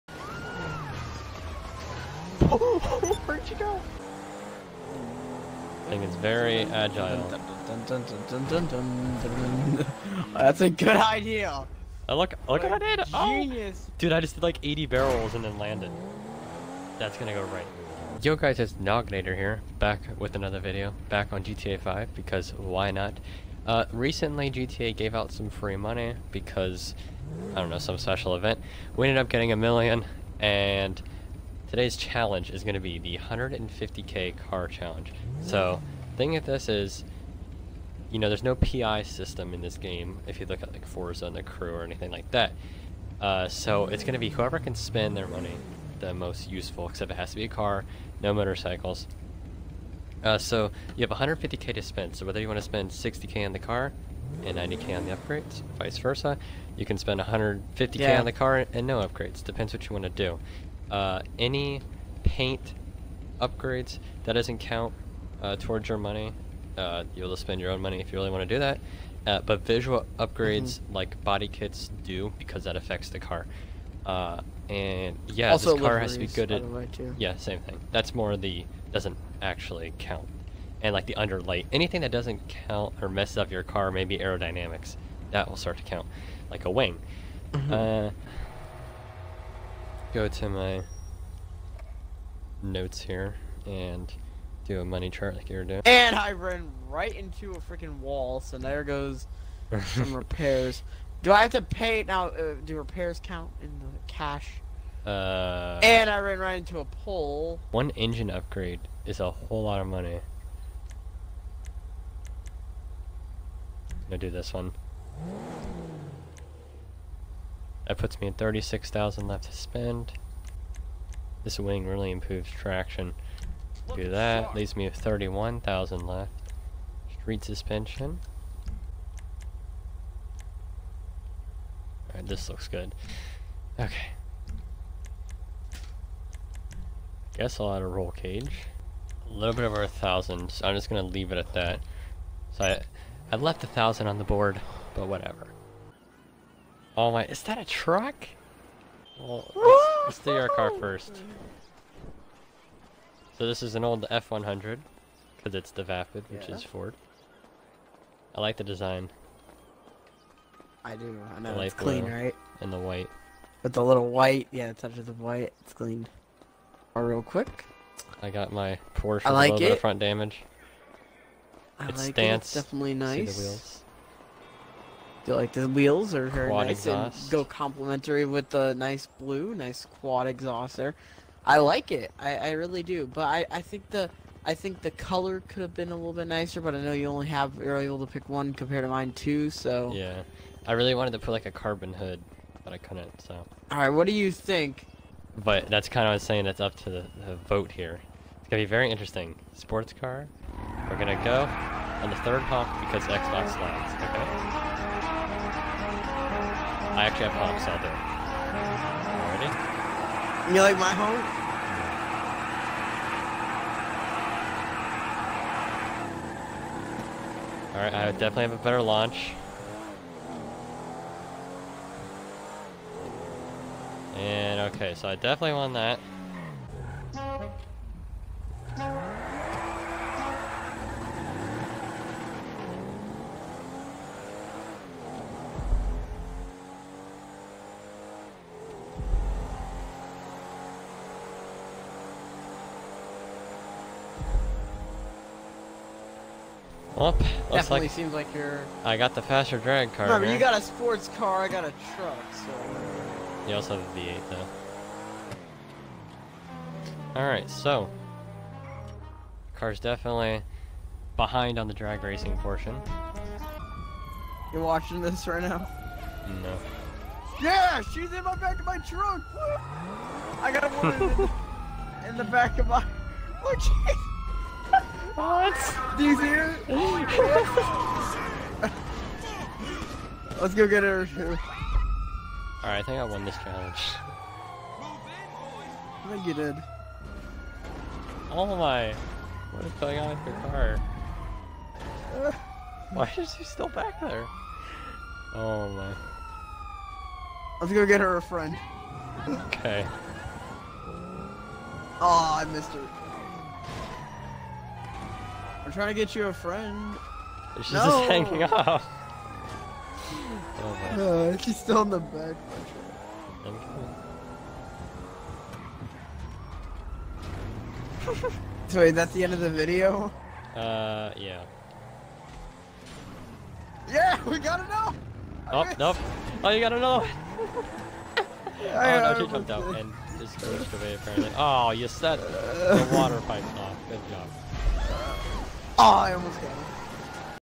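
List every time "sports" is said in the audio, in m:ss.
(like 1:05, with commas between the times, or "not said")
3:19, 4:10.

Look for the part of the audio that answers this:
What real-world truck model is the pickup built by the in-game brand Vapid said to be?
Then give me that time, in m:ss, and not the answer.
2:34.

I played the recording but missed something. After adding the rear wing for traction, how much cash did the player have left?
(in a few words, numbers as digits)
31,000.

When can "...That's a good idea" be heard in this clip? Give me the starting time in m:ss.
0:10.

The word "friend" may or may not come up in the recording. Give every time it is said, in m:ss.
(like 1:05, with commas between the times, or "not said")
4:58, 5:06.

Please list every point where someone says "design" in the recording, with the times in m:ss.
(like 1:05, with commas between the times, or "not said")
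2:38.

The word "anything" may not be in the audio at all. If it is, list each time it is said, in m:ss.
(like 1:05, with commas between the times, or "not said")
0:41, 1:21.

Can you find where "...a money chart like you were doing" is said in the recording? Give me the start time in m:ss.
1:34.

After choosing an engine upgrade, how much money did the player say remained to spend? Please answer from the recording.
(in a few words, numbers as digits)
36,000.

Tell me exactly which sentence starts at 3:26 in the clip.
I actually have hogs out there.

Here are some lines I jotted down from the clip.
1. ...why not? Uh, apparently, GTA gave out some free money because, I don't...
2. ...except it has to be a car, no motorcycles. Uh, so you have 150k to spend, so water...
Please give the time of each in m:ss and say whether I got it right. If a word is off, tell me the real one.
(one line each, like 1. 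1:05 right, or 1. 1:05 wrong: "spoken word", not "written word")
1. 0:22 wrong: "recently", not "apparently"
2. 0:46 wrong: "whether", not "water".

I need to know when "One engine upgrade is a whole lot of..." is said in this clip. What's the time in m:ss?
1:47.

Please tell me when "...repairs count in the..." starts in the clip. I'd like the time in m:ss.
1:42.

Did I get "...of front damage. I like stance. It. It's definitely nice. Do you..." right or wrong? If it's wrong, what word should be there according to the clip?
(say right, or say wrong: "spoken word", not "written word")
right.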